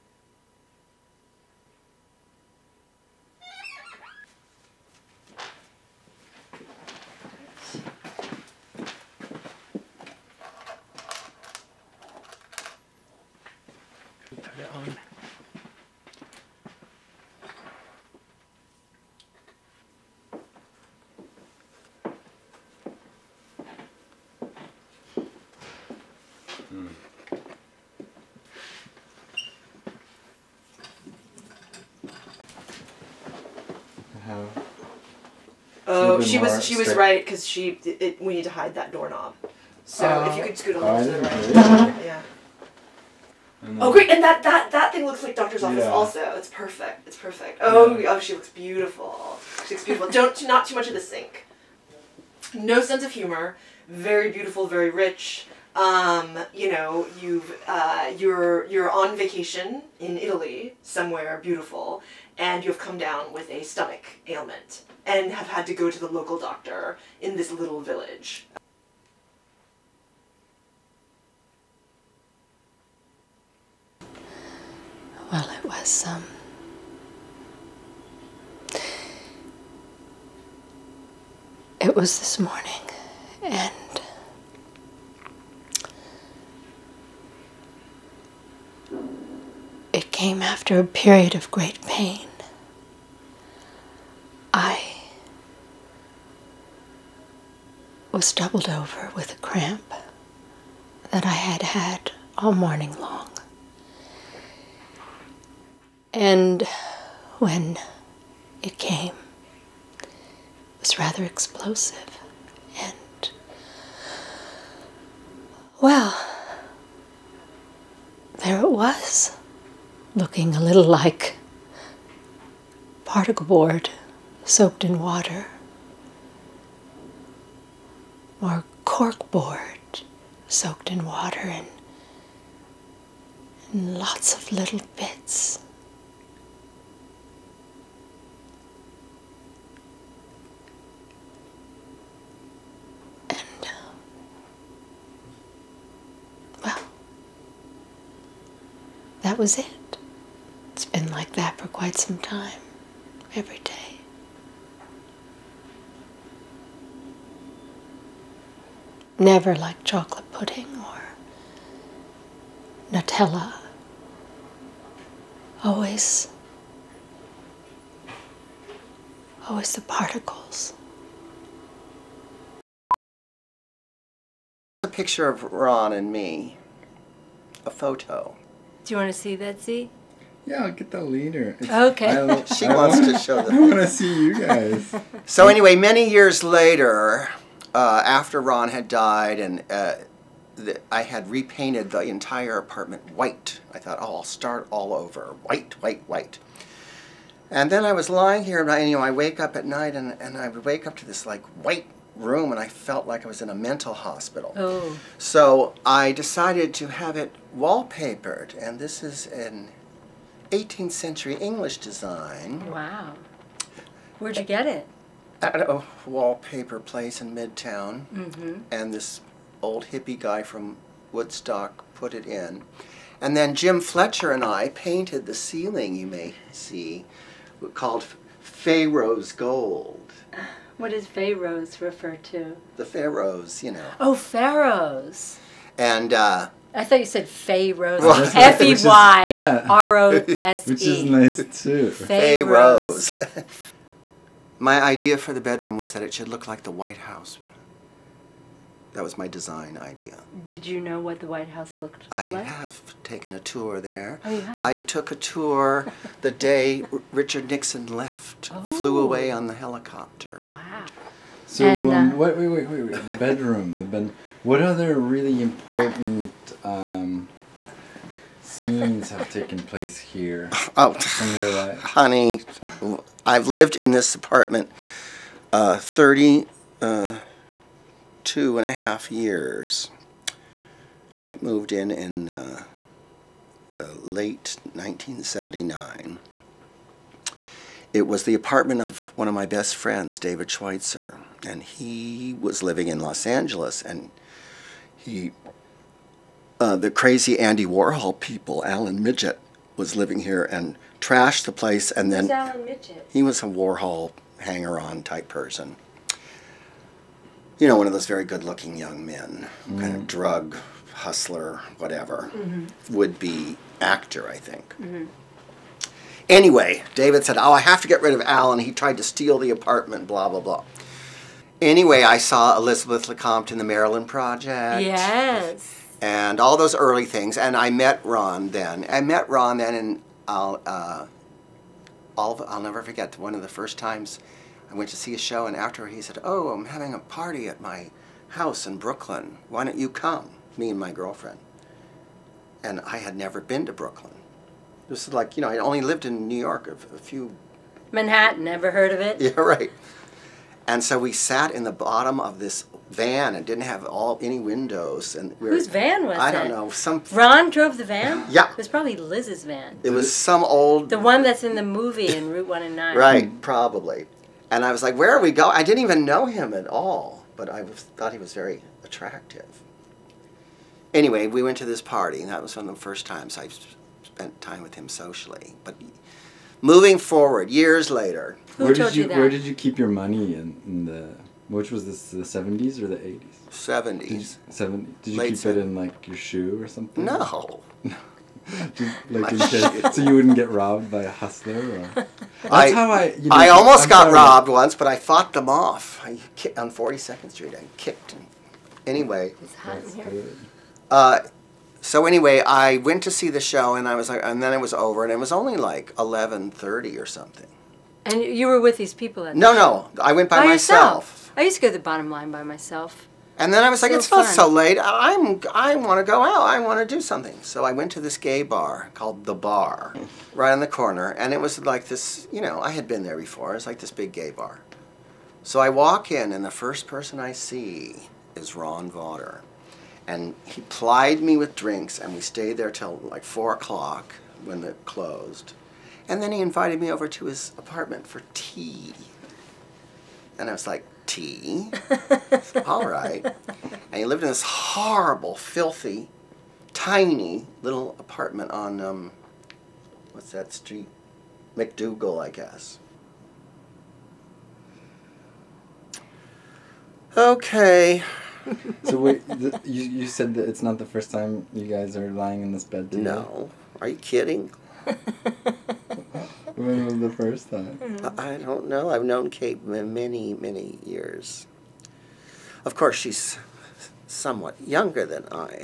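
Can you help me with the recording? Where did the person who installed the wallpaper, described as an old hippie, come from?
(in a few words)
Woodstock.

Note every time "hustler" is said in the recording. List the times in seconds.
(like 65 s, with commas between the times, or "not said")
310 s, 391 s.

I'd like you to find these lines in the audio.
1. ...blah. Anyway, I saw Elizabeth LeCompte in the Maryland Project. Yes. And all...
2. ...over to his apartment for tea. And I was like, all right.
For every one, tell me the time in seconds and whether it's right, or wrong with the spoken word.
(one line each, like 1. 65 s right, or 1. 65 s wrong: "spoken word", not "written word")
1. 320 s right
2. 436 s right.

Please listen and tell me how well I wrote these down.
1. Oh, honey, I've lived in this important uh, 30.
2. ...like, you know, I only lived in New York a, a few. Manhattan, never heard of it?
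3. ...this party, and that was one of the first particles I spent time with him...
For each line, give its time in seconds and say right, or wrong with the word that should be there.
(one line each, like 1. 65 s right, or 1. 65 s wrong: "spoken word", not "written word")
1. 270 s wrong: "apartment", not "important"
2. 345 s right
3. 371 s wrong: "times", not "particles".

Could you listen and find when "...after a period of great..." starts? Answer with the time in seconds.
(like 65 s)
90 s.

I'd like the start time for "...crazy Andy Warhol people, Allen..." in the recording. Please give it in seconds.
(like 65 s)
296 s.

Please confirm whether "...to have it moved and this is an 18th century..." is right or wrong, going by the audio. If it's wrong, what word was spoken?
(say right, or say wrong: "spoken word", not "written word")
wrong: "wallpapered", not "moved".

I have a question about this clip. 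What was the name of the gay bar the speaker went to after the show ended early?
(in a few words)
The Bar.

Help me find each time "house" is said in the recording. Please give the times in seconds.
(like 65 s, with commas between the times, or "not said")
246 s, 251 s, 338 s.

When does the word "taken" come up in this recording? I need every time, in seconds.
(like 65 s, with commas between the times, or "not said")
253 s, 269 s.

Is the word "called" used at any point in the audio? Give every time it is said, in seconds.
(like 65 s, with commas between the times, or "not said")
227 s, 418 s.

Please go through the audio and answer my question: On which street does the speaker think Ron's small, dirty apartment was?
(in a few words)
MacDougal.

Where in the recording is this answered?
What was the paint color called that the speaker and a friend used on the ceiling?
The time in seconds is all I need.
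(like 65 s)
228 s.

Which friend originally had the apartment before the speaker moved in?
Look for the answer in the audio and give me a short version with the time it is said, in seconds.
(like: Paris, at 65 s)
David Schweitzer, at 290 s.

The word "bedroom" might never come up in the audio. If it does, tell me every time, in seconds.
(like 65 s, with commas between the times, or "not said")
245 s, 263 s.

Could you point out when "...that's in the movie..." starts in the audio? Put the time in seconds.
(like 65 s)
361 s.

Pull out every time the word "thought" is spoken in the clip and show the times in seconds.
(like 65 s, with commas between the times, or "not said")
193 s, 236 s, 367 s.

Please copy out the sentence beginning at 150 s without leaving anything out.
It's been like that for quite some time, every day.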